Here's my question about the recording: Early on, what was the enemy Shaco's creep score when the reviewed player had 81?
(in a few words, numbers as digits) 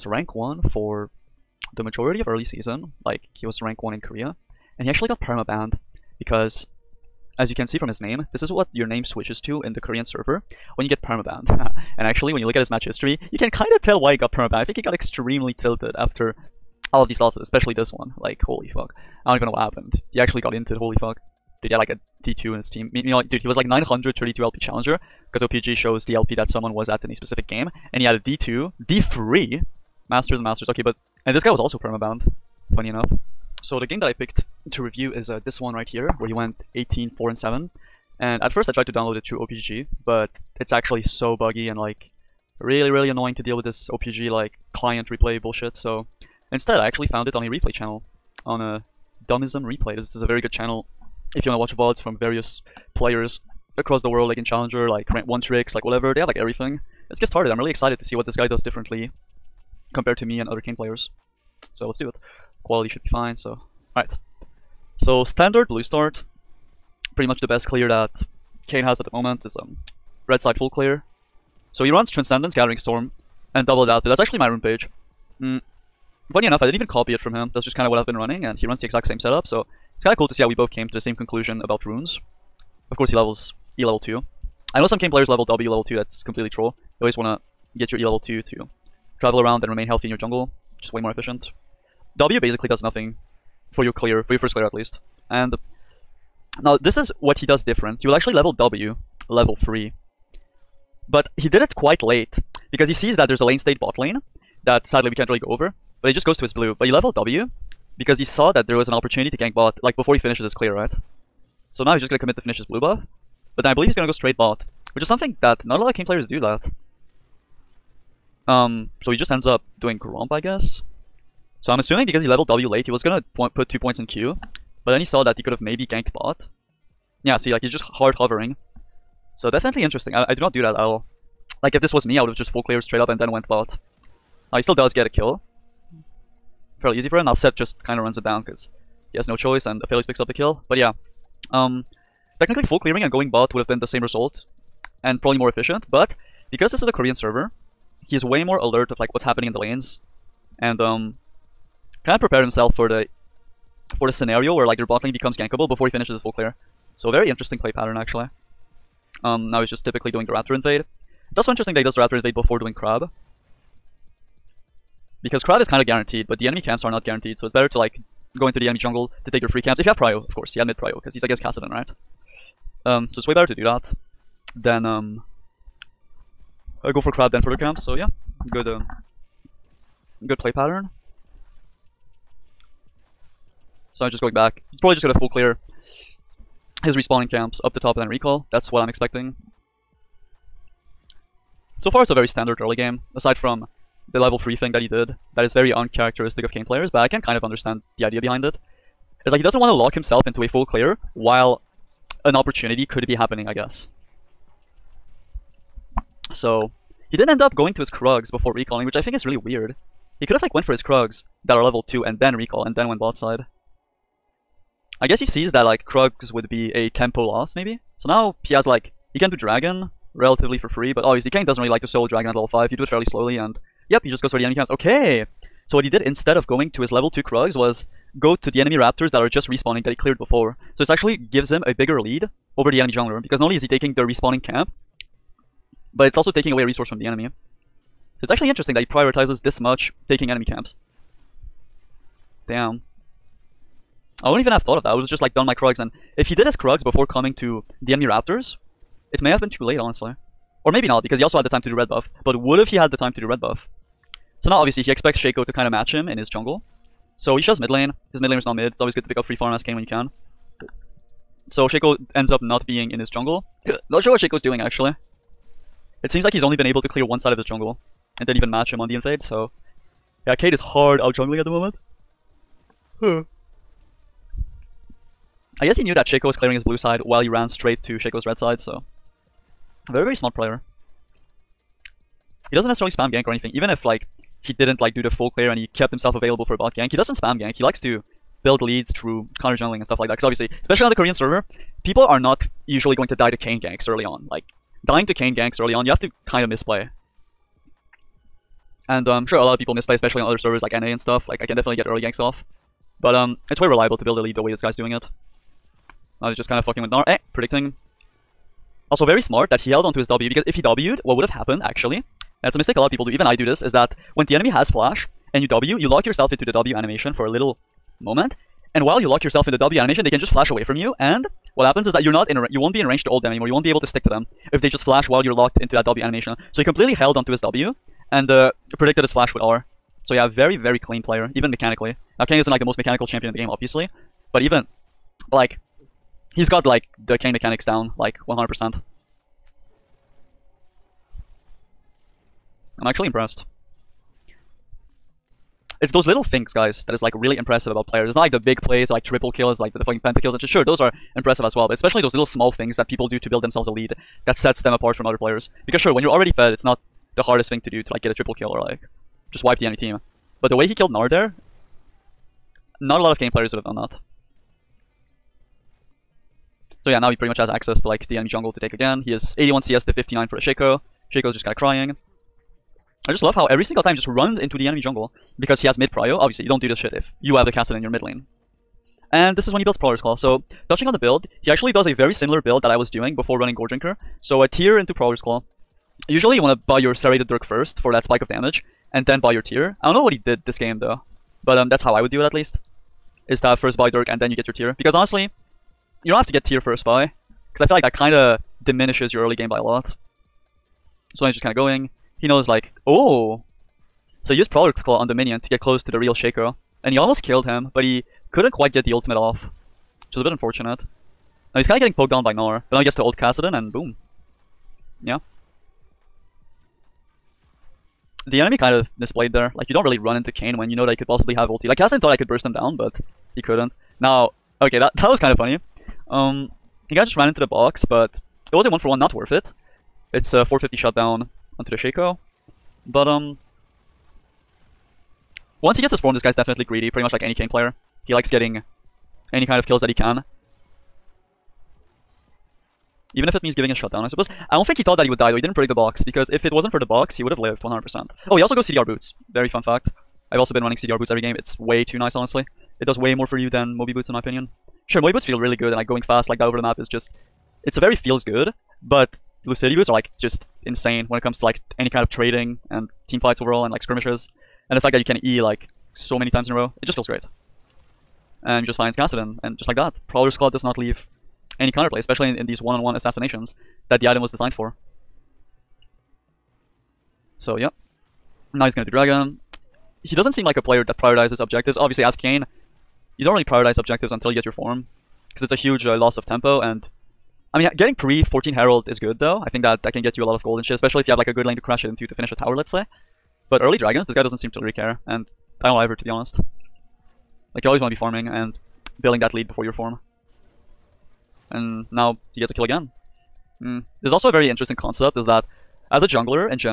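59.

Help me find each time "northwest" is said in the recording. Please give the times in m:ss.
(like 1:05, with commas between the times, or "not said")
not said.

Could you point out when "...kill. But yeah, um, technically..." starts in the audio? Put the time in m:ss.
2:20.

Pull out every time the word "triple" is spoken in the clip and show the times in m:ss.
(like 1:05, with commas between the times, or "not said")
5:49, 5:58.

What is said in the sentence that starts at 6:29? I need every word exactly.
I don't know what he did this game though, but um, that's how I would do it at least.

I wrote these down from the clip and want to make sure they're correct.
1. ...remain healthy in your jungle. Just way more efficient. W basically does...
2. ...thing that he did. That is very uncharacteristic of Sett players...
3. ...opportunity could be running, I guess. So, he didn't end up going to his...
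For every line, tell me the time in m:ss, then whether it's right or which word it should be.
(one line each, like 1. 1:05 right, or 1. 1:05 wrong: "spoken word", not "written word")
1. 1:29 right
2. 3:14 wrong: "Kayn", not "Sett"
3. 3:22 wrong: "happening", not "running".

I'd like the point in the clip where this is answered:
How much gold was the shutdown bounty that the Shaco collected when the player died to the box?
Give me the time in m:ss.
7:10.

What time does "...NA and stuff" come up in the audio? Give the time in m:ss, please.
5:00.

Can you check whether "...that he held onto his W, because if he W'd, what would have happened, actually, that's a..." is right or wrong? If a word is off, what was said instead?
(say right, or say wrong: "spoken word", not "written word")
right.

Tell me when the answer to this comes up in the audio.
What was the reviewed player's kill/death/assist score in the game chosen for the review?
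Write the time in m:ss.
0:36.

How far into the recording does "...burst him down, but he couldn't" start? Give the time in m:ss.
7:02.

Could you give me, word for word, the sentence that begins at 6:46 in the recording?
And he almost killed him, but he couldn't quite get the ultimate off.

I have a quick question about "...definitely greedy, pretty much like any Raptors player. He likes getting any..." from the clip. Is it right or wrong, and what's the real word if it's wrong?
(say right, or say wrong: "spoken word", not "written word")
wrong: "Kayn", not "Raptors".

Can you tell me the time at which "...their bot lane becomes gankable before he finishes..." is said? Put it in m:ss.
2:34.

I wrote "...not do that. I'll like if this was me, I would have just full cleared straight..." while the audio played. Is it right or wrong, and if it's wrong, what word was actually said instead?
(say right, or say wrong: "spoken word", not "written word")
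right.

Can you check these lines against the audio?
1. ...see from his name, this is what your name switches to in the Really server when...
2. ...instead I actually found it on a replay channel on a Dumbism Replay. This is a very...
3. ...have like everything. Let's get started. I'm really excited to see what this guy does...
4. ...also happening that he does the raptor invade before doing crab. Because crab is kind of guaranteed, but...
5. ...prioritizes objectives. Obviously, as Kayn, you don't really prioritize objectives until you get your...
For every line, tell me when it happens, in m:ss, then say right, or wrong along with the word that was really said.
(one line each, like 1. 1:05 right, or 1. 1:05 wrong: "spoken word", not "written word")
1. 0:07 wrong: "Korean", not "Really"
2. 0:46 right
3. 0:56 right
4. 2:41 wrong: "interesting", not "happening"
5. 8:00 right.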